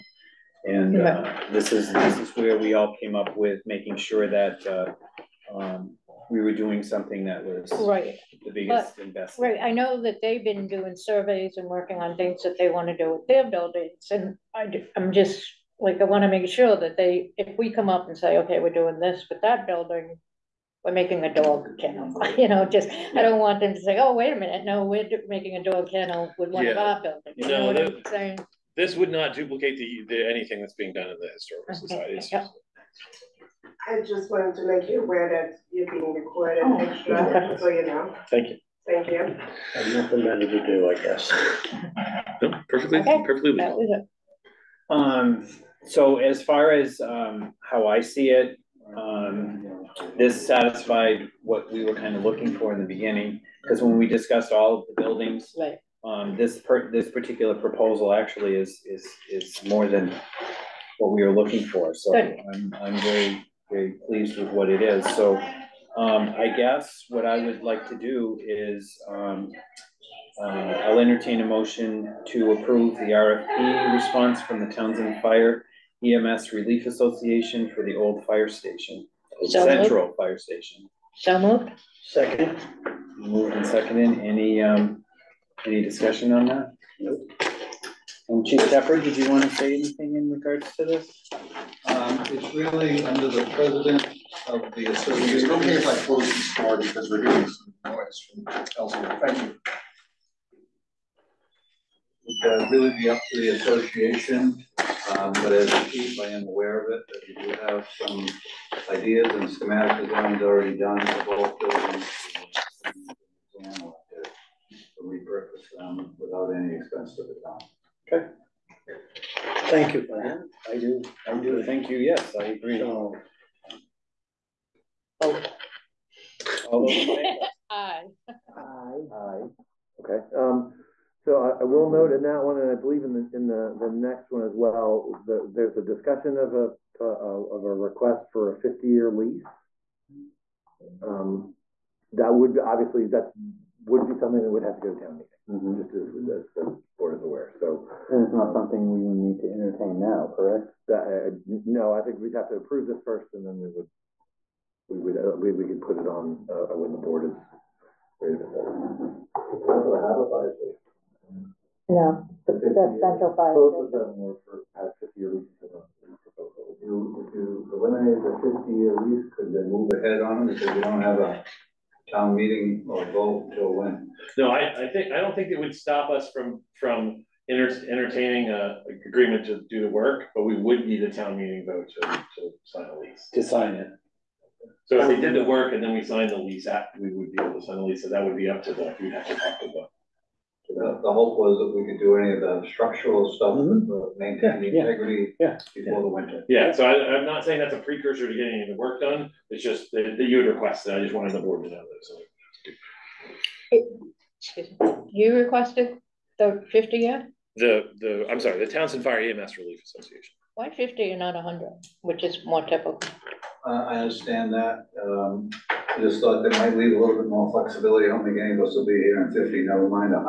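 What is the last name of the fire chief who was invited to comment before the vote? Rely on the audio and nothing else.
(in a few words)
Shepherd.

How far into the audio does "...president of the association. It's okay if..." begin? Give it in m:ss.
1:33.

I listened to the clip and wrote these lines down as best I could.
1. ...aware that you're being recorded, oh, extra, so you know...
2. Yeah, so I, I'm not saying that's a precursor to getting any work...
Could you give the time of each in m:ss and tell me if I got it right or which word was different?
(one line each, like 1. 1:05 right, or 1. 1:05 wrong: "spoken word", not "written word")
1. 0:35 right
2. 3:16 right.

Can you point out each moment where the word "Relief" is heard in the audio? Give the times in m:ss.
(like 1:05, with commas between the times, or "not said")
1:16, 3:29.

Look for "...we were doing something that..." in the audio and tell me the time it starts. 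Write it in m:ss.
0:06.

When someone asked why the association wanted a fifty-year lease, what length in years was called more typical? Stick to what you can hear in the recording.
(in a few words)
100.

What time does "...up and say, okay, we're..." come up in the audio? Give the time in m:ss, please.
0:17.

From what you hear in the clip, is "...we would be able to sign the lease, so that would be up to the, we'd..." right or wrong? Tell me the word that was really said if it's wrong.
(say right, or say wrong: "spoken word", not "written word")
right.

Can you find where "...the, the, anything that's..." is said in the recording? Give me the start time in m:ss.
0:29.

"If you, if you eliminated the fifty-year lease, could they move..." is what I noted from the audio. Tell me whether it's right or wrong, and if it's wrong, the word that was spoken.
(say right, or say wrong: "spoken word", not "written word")
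right.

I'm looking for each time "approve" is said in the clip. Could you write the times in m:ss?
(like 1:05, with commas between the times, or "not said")
1:12, 2:32.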